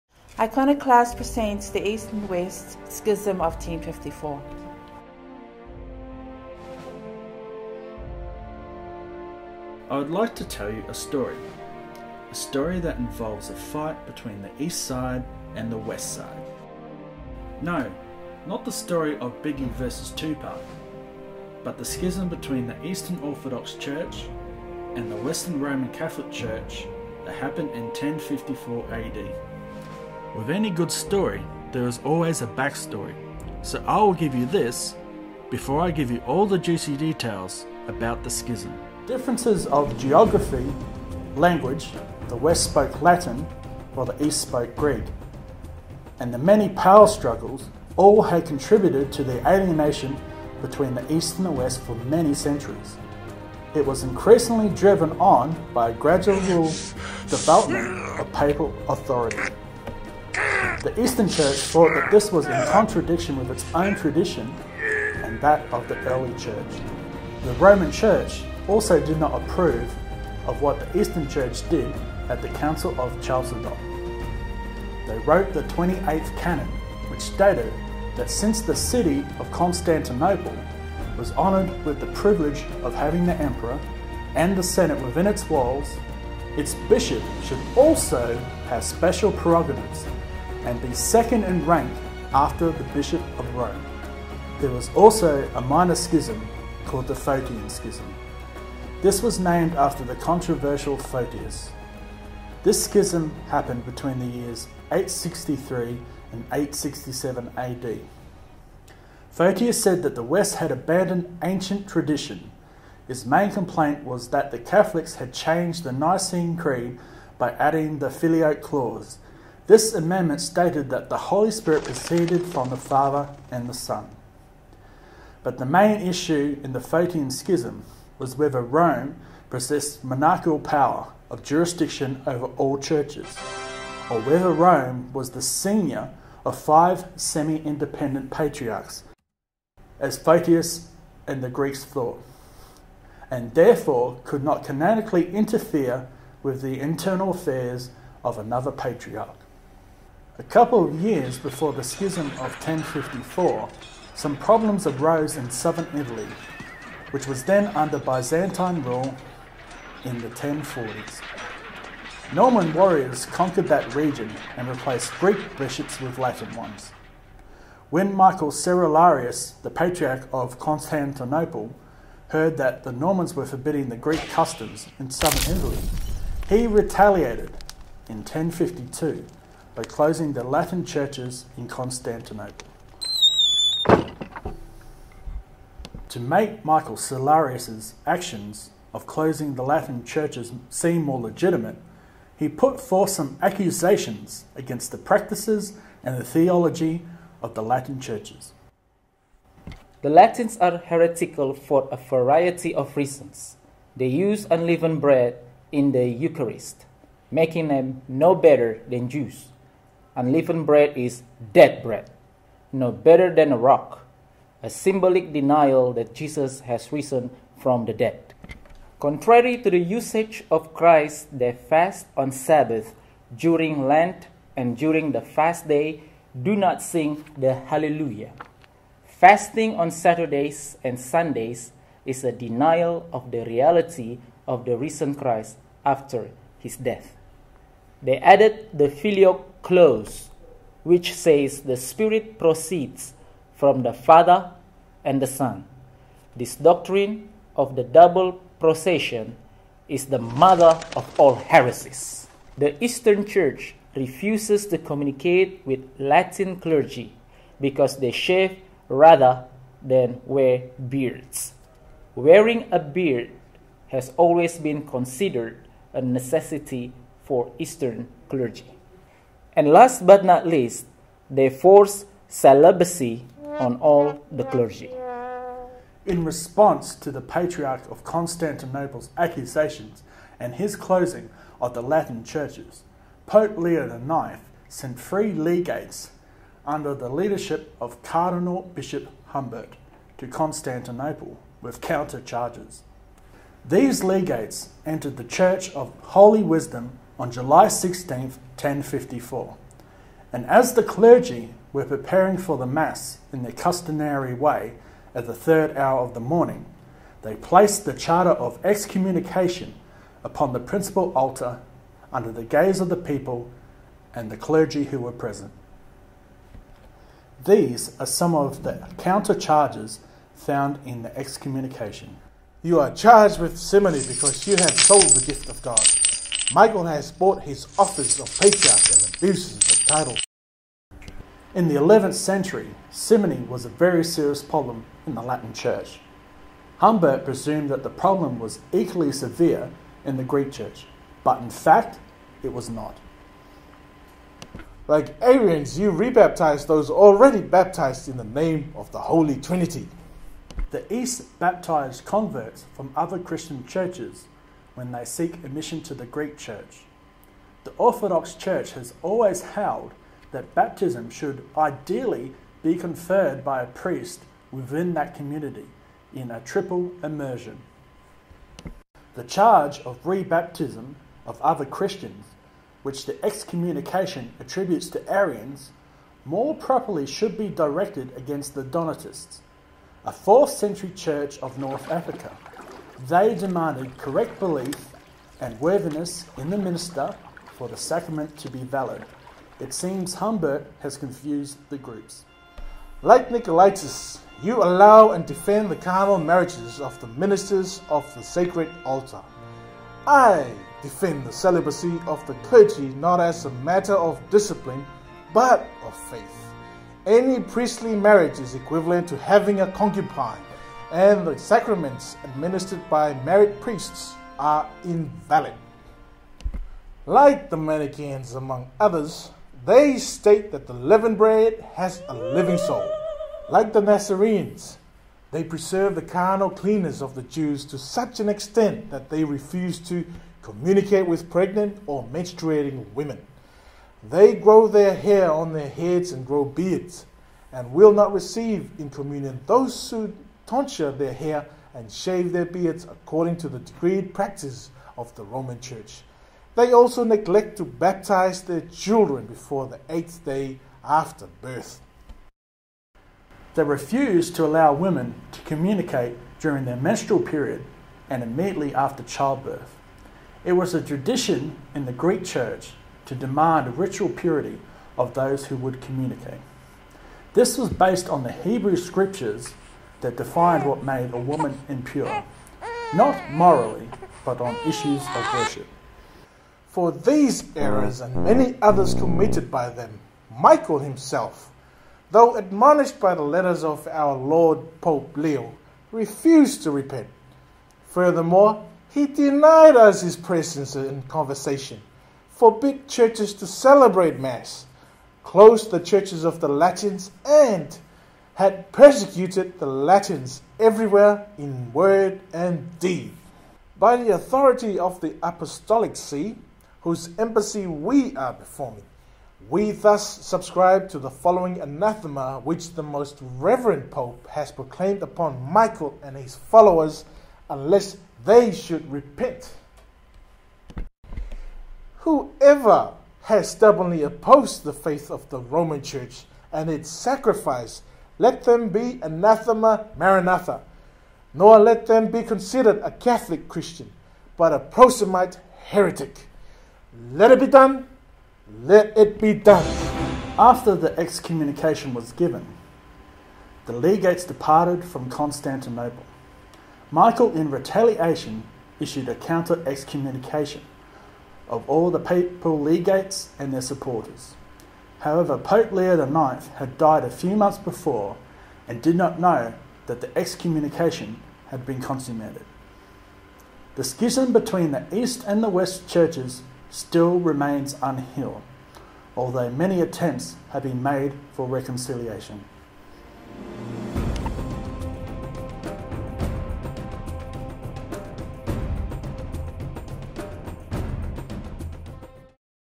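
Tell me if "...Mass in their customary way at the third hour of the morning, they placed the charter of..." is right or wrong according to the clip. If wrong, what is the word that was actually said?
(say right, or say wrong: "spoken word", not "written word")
right.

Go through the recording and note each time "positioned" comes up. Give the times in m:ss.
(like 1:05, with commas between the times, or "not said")
not said.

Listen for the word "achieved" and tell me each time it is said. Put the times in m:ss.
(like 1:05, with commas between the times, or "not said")
not said.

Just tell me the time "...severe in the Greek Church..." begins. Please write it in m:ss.
5:39.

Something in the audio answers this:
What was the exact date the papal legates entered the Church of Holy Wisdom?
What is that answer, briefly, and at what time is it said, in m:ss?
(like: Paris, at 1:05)
July 16, 1054, at 4:57.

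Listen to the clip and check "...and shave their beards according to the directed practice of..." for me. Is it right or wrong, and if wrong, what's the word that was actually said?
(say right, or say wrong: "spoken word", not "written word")
wrong: "decreed", not "directed".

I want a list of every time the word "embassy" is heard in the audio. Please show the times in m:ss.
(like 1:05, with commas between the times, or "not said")
8:27.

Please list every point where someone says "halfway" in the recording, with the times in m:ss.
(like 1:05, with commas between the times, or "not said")
not said.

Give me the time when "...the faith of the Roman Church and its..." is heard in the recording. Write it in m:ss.
8:44.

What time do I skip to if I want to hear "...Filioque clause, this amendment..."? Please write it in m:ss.
1:58.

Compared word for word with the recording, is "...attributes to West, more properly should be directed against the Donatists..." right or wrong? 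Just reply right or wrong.
wrong.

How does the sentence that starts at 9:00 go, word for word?
After the excommunication was given, the legates departed from Constantinople.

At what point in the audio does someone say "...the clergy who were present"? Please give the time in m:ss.
5:14.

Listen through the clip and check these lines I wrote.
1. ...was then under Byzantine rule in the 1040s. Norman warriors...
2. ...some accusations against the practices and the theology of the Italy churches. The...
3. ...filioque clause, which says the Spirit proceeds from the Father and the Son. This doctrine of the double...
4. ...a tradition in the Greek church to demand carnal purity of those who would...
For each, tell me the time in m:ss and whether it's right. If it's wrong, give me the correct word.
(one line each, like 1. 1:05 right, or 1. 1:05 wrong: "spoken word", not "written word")
1. 2:37 right
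2. 3:13 wrong: "Latin", not "Italy"
3. 3:58 right
4. 7:40 wrong: "ritual", not "carnal".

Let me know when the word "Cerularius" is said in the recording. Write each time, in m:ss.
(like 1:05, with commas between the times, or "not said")
2:48, 3:06.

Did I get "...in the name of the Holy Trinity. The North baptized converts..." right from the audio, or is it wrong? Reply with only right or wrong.
wrong.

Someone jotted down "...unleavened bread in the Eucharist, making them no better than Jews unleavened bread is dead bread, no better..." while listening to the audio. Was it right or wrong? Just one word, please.
right.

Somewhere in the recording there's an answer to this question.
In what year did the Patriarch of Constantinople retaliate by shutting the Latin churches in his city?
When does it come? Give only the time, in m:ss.
2:58.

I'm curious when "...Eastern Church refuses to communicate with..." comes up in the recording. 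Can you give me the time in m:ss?
4:12.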